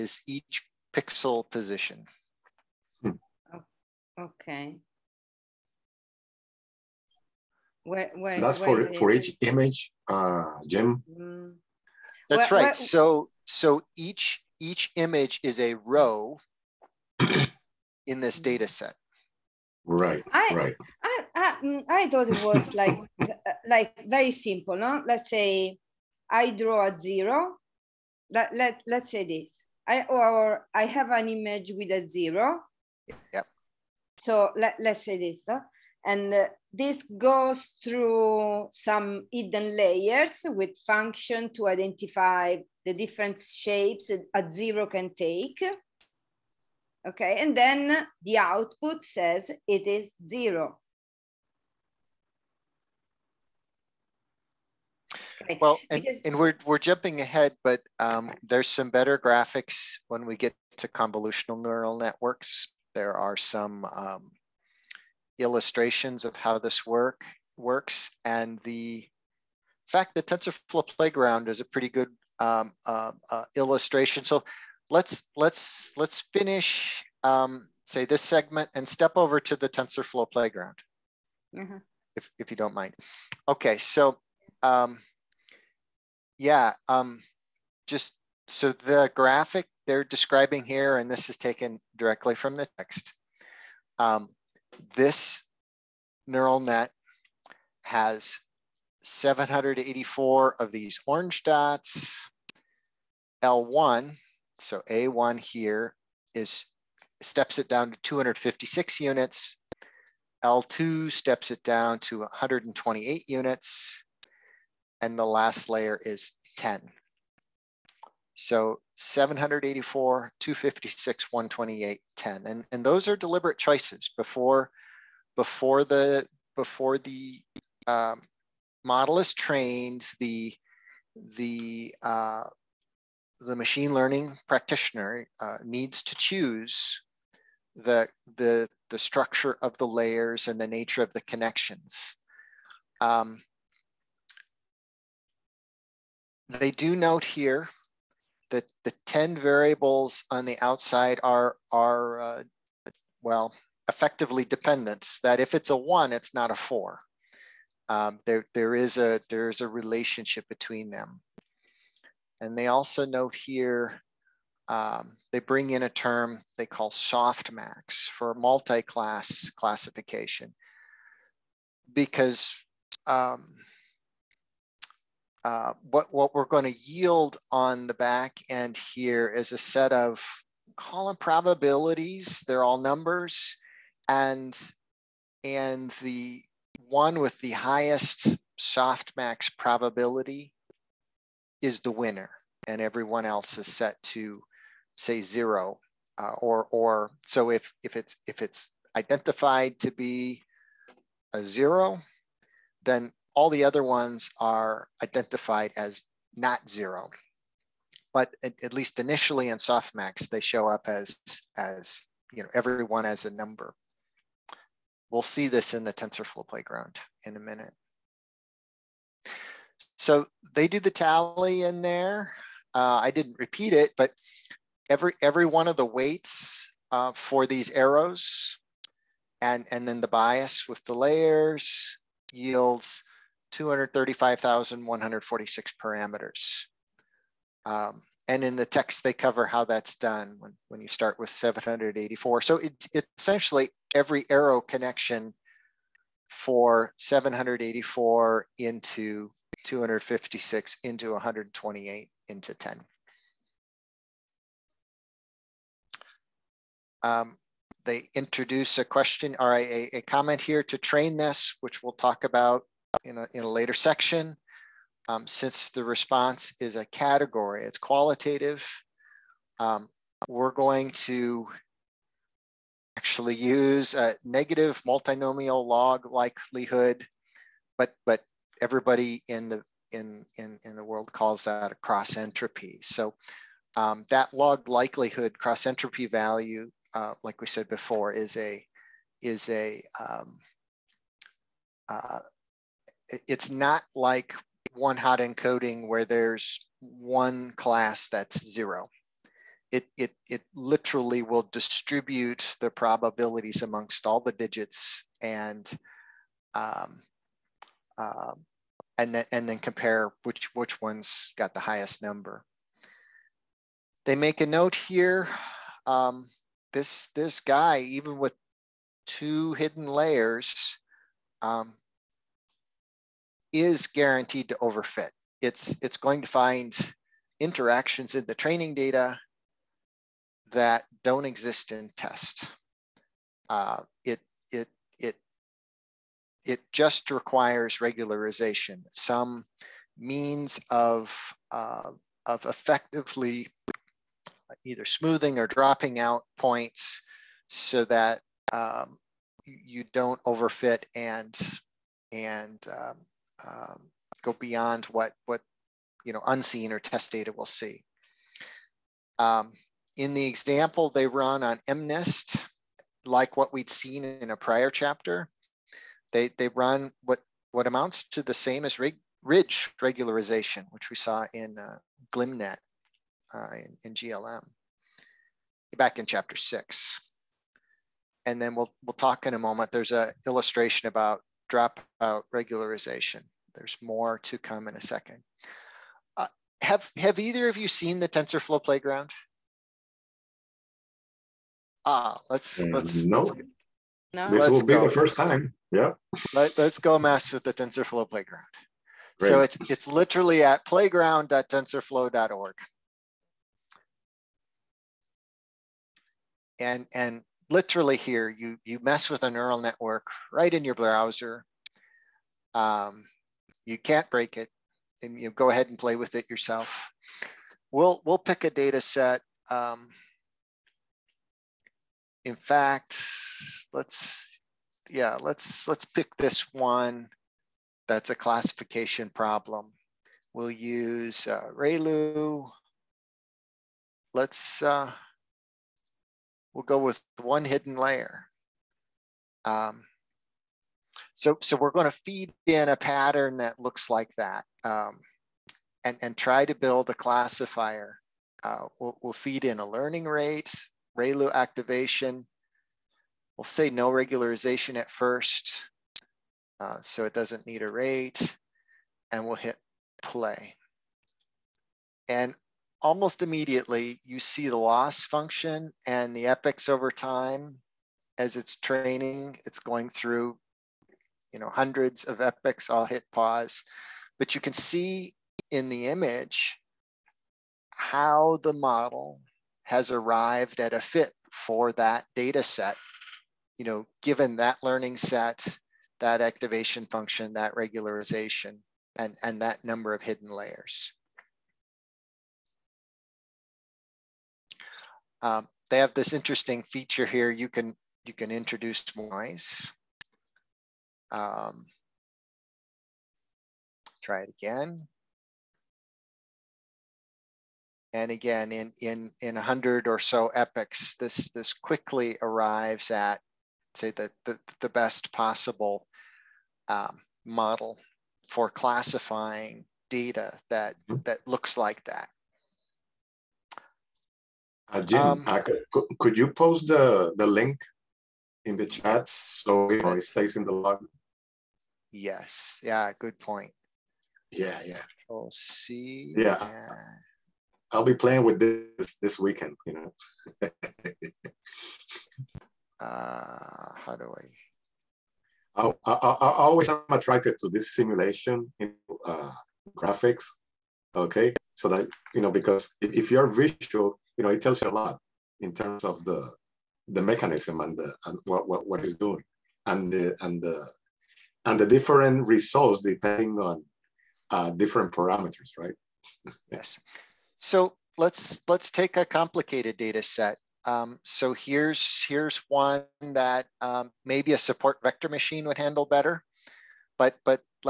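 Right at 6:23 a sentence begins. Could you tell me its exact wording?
There's more to come in a second.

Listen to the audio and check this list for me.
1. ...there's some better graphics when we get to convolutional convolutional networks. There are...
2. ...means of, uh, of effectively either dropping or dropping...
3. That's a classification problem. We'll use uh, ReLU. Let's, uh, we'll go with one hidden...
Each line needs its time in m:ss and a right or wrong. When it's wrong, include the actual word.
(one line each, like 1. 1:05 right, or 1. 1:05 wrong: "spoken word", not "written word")
1. 0:58 wrong: "neural", not "convolutional"
2. 5:39 wrong: "smoothing", not "dropping"
3. 7:07 right.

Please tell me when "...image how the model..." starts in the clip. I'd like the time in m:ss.
7:55.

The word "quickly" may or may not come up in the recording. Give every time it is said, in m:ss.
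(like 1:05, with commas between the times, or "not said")
8:31.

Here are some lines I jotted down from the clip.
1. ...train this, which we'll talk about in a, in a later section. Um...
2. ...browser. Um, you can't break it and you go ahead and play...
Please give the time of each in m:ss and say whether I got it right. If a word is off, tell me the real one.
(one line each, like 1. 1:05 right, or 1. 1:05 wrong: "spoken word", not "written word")
1. 4:20 right
2. 6:50 right.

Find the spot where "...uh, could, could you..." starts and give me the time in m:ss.
8:45.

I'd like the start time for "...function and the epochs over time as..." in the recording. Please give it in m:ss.
7:45.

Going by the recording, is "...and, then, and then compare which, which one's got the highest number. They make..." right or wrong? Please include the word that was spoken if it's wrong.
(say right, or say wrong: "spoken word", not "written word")
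right.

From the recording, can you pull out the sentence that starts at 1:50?
L2 steps it down to 128 units and the last layer is 10.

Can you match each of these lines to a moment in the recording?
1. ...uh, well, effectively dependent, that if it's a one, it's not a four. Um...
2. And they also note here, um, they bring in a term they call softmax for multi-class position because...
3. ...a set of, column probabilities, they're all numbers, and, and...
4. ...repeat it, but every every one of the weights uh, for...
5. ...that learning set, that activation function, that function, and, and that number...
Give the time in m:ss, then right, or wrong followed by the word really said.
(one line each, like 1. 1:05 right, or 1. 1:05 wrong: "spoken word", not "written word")
1. 2:32 right
2. 2:42 wrong: "classification", not "position"
3. 2:59 right
4. 3:43 right
5. 8:04 wrong: "regularization", not "function".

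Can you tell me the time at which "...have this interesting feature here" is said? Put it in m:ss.
8:15.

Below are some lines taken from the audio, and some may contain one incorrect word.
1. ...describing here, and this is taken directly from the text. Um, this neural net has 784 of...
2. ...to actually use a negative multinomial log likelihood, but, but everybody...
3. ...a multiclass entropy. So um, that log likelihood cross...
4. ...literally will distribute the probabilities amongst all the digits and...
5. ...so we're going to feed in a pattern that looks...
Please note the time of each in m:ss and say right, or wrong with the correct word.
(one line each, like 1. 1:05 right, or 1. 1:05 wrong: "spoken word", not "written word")
1. 1:30 right
2. 4:30 right
3. 4:41 wrong: "cross", not "multiclass"
4. 5:00 right
5. 7:21 right.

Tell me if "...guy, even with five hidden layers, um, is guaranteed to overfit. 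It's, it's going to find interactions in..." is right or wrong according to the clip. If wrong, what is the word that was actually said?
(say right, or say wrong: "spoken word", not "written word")
wrong: "two", not "five".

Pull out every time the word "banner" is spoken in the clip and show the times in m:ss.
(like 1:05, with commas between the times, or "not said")
not said.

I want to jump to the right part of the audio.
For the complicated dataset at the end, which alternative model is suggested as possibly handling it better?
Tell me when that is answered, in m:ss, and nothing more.
9:34.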